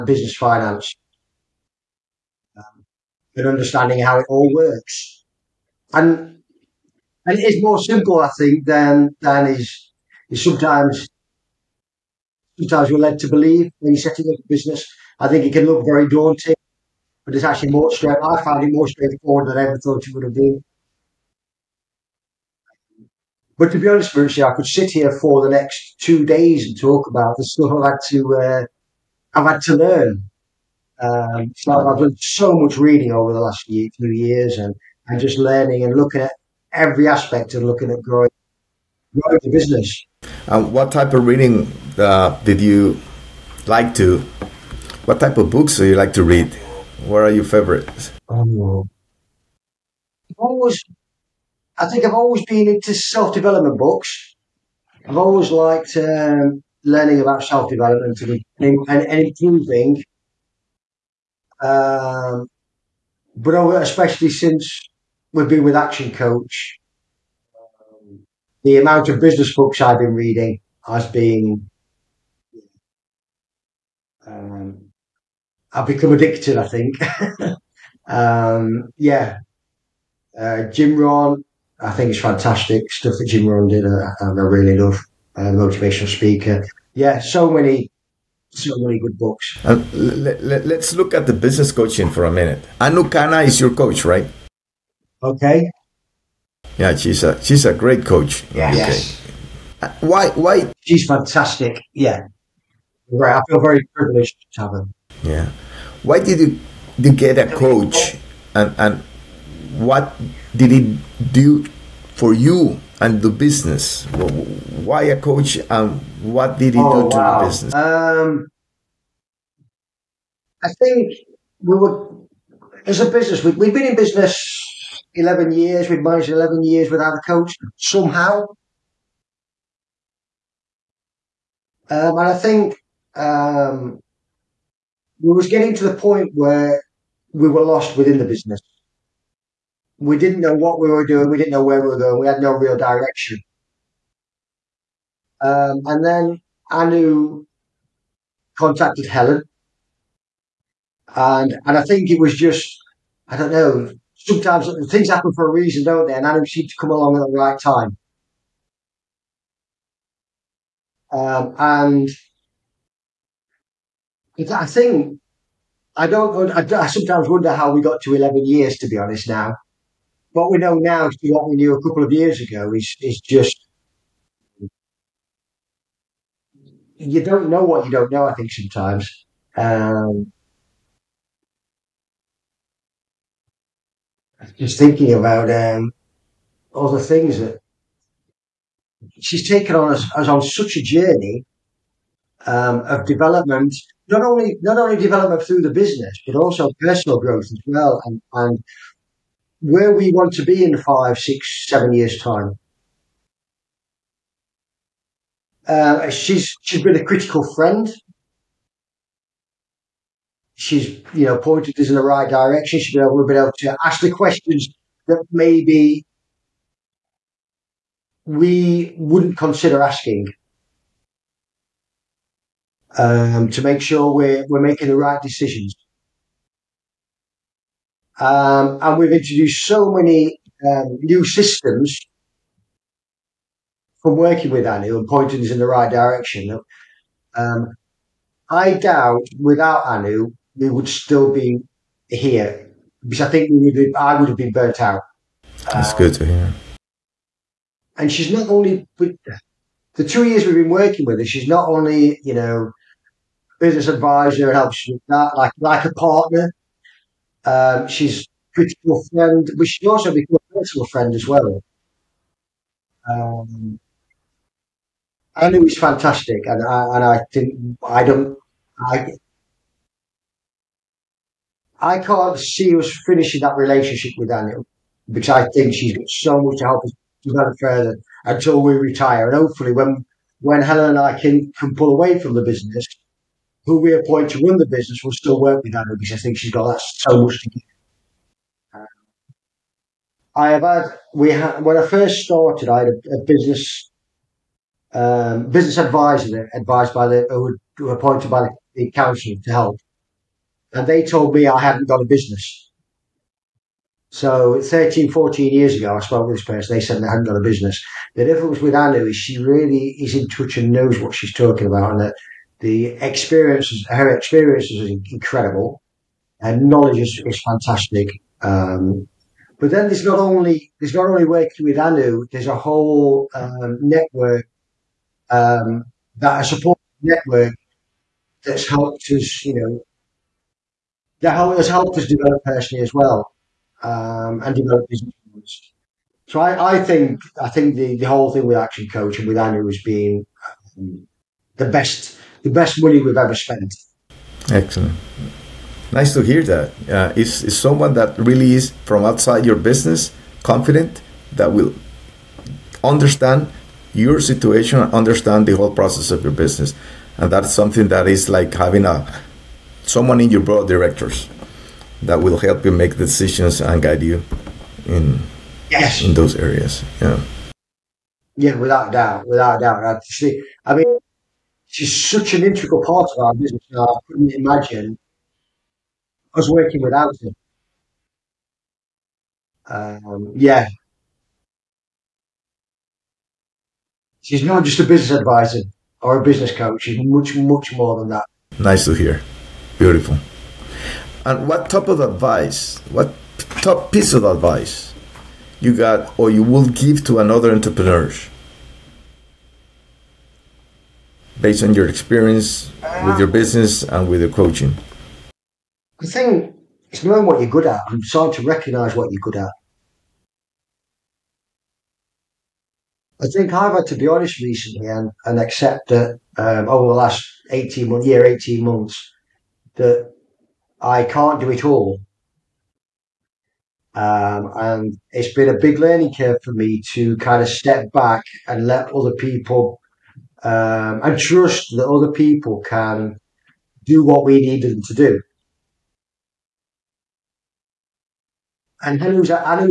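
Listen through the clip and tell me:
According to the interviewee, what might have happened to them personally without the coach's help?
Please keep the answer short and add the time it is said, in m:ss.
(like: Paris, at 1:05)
burnt out, at 4:03.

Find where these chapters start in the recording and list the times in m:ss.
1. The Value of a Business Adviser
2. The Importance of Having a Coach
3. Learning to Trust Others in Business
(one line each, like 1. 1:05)
1. 4:21
2. 1:30
3. 6:53.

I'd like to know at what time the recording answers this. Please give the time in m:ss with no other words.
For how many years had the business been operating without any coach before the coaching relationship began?
2:03.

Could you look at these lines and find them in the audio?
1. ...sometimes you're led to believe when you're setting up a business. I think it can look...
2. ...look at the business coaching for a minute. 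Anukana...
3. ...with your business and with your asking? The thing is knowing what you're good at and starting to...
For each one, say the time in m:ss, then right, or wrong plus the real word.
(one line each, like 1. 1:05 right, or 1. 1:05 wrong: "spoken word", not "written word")
1. 0:12 right
2. 1:30 right
3. 6:43 wrong: "coaching", not "asking".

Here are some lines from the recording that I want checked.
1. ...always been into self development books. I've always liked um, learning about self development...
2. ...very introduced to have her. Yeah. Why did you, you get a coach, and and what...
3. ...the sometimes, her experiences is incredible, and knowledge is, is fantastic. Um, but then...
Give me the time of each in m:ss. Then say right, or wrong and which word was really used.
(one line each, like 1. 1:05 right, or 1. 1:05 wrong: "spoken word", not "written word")
1. 0:52 right
2. 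1:43 wrong: "privileged", not "introduced"
3. 5:12 wrong: "experiences", not "sometimes".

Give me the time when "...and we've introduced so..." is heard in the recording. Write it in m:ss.
3:48.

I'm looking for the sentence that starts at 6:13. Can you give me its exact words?
Uh, I couldn't imagine us working without her.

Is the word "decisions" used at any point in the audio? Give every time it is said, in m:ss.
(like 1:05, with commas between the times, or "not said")
3:45, 6:02.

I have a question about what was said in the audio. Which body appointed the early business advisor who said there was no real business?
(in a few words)
the council.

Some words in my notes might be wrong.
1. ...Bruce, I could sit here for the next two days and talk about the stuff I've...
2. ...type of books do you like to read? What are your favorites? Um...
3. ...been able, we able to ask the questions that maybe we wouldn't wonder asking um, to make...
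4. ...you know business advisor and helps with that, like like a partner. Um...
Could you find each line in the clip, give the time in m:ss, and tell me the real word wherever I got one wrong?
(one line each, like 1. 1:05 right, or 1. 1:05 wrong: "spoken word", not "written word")
1. 0:24 right
2. 0:45 right
3. 3:32 wrong: "consider", not "wonder"
4. 4:12 right.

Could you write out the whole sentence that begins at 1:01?
Um, but especially since we've been with Action Coach.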